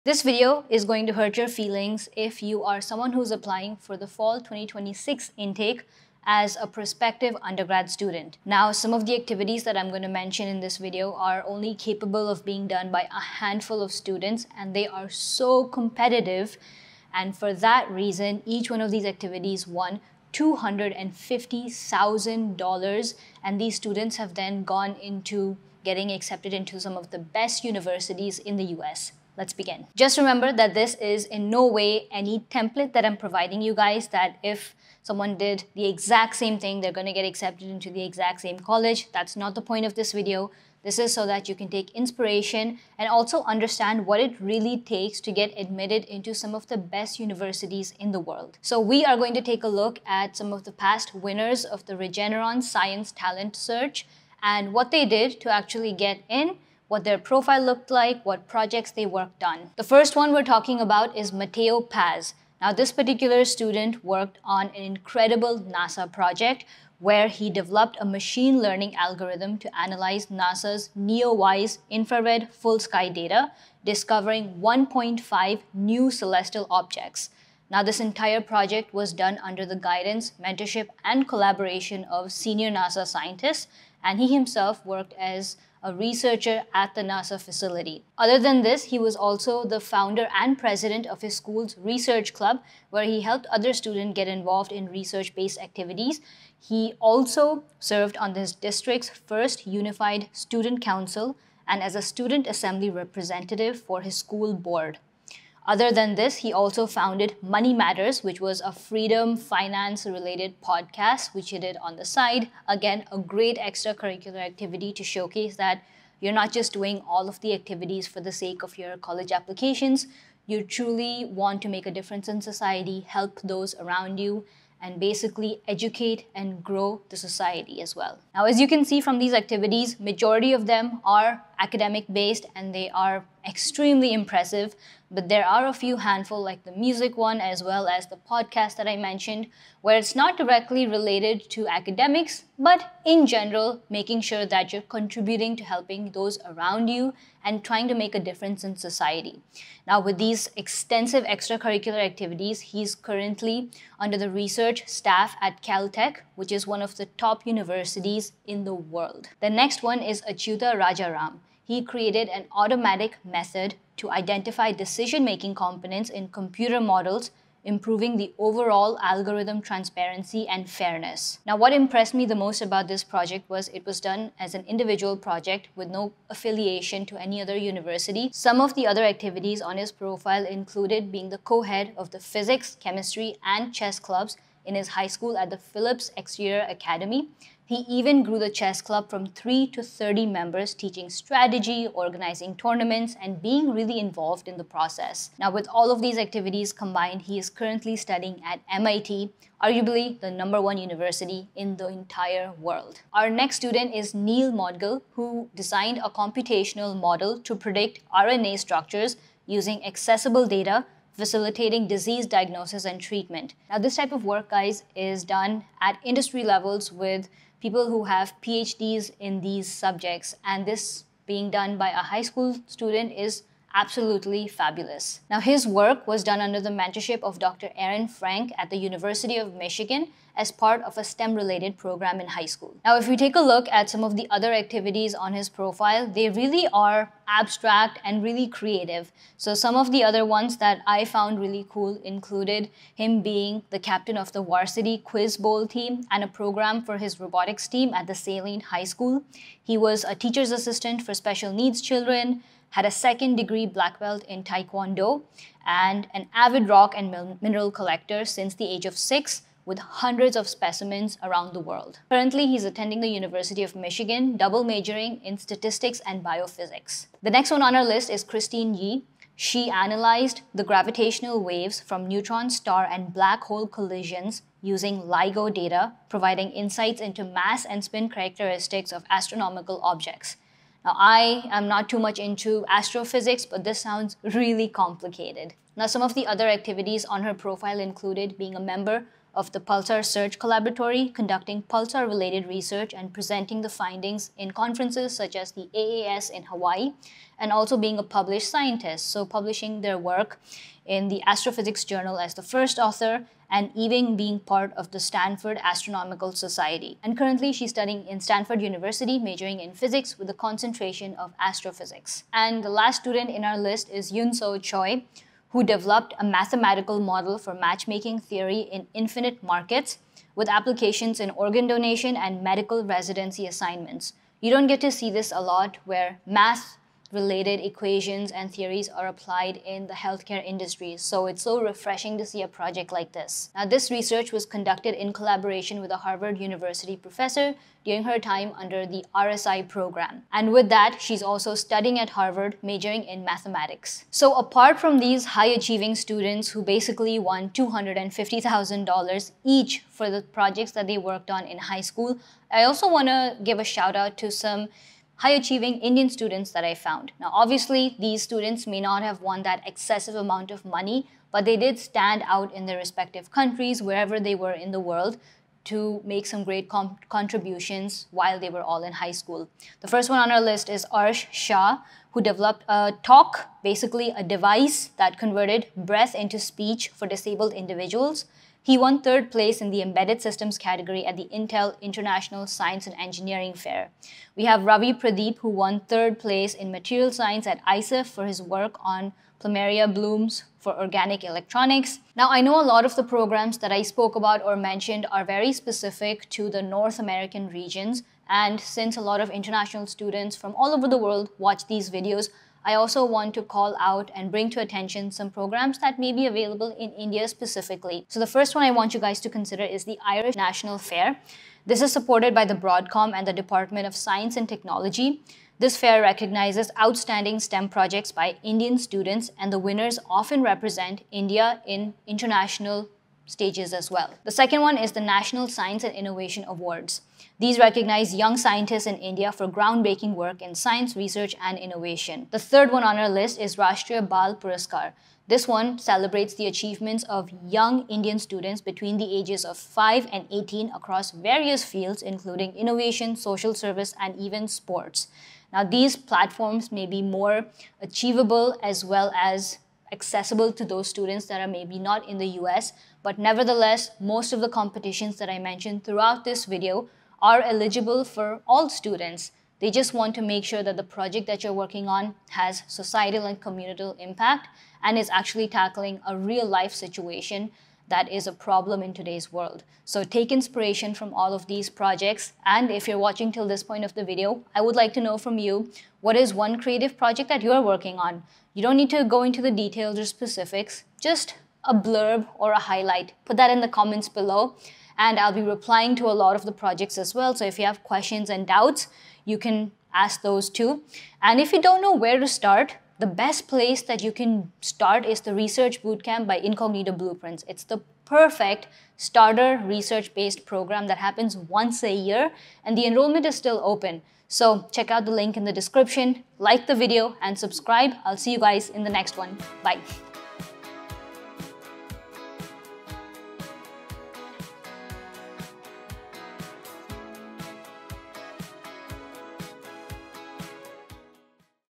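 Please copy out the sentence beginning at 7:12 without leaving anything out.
The third one on our list is Rashtriya Bal Puraskar.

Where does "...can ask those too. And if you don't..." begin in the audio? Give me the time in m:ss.
8:09.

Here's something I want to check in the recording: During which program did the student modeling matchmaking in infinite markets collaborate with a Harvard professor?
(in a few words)
RSI.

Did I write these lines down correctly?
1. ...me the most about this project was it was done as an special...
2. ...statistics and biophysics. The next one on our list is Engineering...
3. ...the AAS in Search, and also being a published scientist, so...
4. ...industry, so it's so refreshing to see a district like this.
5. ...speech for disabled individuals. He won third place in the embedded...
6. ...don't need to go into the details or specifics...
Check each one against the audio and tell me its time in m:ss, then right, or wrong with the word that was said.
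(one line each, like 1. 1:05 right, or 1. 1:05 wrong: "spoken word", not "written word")
1. 2:52 wrong: "individual", not "special"
2. 4:25 wrong: "Christine", not "Engineering"
3. 4:55 wrong: "Hawaii", not "Search"
4. 5:30 wrong: "project", not "district"
5. 6:16 right
6. 7:58 right.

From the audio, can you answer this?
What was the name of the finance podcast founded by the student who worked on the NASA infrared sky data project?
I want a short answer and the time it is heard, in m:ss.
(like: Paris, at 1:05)
Money Matters, at 1:47.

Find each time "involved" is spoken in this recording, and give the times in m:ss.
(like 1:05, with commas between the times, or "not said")
1:34, 3:13.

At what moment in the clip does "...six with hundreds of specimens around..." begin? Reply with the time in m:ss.
4:18.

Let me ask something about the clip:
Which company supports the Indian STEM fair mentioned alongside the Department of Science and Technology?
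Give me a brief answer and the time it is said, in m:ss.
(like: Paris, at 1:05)
Broadcom, at 6:52.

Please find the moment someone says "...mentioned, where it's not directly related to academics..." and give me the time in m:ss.
2:18.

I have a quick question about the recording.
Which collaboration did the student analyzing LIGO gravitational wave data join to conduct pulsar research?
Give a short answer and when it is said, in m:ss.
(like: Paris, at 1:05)
Pulsar Search Collaboratory, at 4:49.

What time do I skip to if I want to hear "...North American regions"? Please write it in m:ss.
6:36.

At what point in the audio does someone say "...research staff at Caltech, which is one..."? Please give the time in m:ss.
2:34.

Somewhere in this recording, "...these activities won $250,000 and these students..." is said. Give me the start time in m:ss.
0:18.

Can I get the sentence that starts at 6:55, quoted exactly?
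This fair recognizes outstanding STEM projects by Indian students and the winners often represent India in international stages as well.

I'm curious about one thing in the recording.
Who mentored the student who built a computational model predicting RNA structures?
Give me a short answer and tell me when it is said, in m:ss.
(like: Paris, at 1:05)
Dr. Aaron Frank, at 3:47.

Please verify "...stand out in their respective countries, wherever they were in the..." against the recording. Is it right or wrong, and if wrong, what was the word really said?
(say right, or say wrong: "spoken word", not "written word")
right.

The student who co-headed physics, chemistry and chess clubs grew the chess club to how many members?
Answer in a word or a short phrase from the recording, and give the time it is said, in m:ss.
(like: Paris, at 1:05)
30, at 3:09.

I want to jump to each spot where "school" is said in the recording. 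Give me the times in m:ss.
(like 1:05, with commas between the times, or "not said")
1:31, 1:44, 3:05, 3:42, 3:52, 4:08, 5:51, 6:09.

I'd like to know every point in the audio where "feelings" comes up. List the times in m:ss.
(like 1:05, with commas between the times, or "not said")
0:01.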